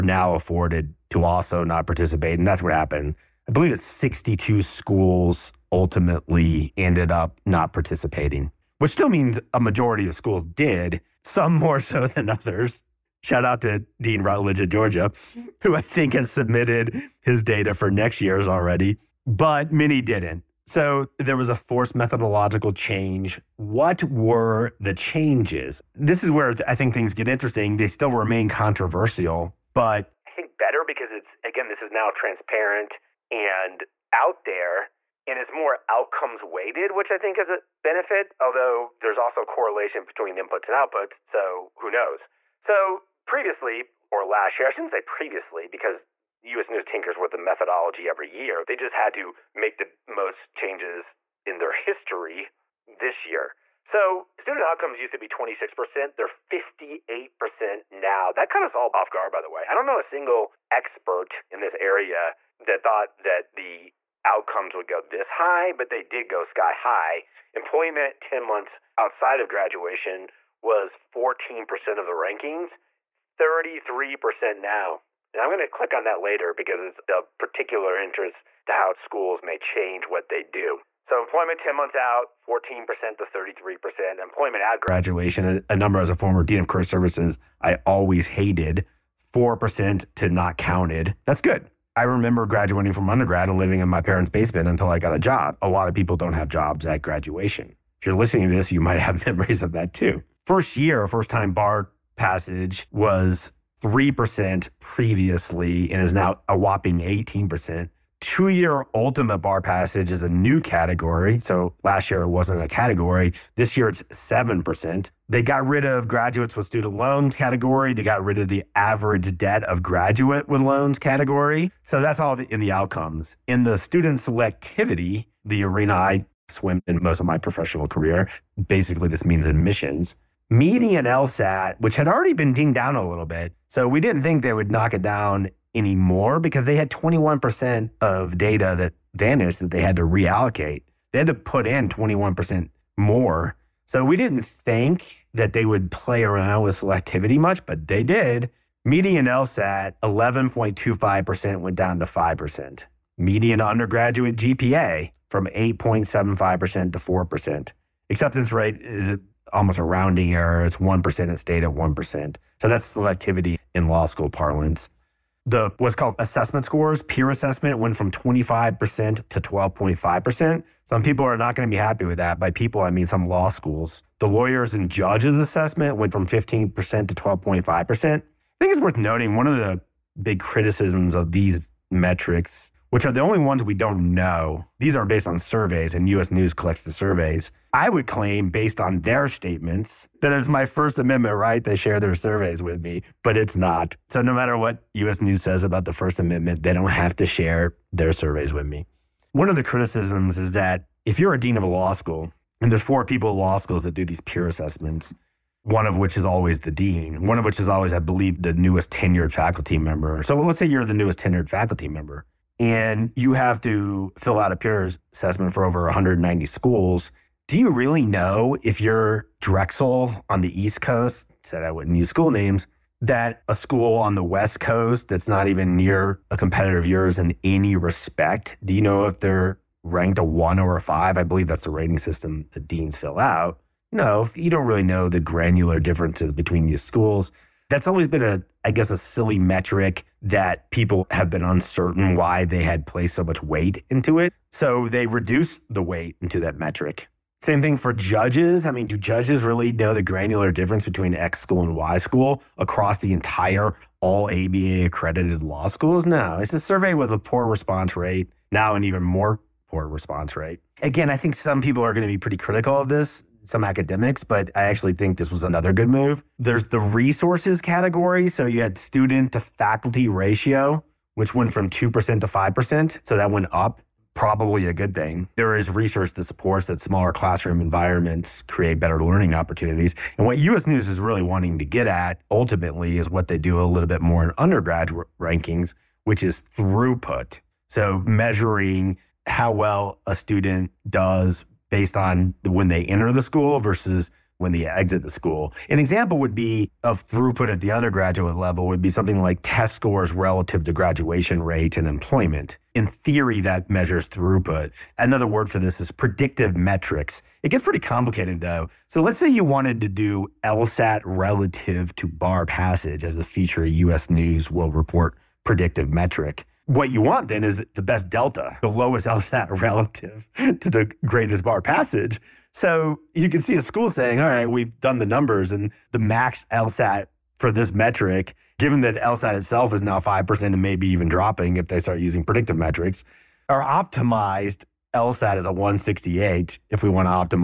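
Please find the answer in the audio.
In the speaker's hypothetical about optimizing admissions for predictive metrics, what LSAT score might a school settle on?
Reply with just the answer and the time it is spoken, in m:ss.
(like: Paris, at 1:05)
168, at 5:35.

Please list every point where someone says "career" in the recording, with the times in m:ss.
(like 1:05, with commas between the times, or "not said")
1:26, 2:07.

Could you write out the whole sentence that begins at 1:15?
And I'm going to click on that later because it's of particular interest to how schools may change what they do.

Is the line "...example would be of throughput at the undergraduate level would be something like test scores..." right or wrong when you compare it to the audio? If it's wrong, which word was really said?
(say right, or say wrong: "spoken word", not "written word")
right.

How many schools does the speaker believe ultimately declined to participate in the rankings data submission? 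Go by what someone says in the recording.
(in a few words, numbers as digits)
62.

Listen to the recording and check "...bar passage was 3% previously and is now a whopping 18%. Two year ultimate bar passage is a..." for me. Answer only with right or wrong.
right.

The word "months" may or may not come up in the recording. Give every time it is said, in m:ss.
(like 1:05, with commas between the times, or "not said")
1:08, 1:21.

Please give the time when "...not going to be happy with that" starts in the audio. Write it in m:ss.
2:51.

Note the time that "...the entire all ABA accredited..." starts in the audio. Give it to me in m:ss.
4:12.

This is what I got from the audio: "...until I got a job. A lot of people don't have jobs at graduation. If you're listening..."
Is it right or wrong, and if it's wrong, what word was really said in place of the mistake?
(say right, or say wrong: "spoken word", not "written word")
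right.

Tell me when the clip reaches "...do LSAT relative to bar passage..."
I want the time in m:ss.
5:09.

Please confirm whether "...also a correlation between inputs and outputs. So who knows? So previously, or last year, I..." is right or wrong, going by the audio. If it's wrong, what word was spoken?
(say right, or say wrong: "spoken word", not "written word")
right.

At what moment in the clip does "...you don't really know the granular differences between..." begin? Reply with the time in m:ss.
3:54.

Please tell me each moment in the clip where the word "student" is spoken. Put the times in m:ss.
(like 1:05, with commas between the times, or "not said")
0:54, 1:56, 2:03, 4:28, 4:50.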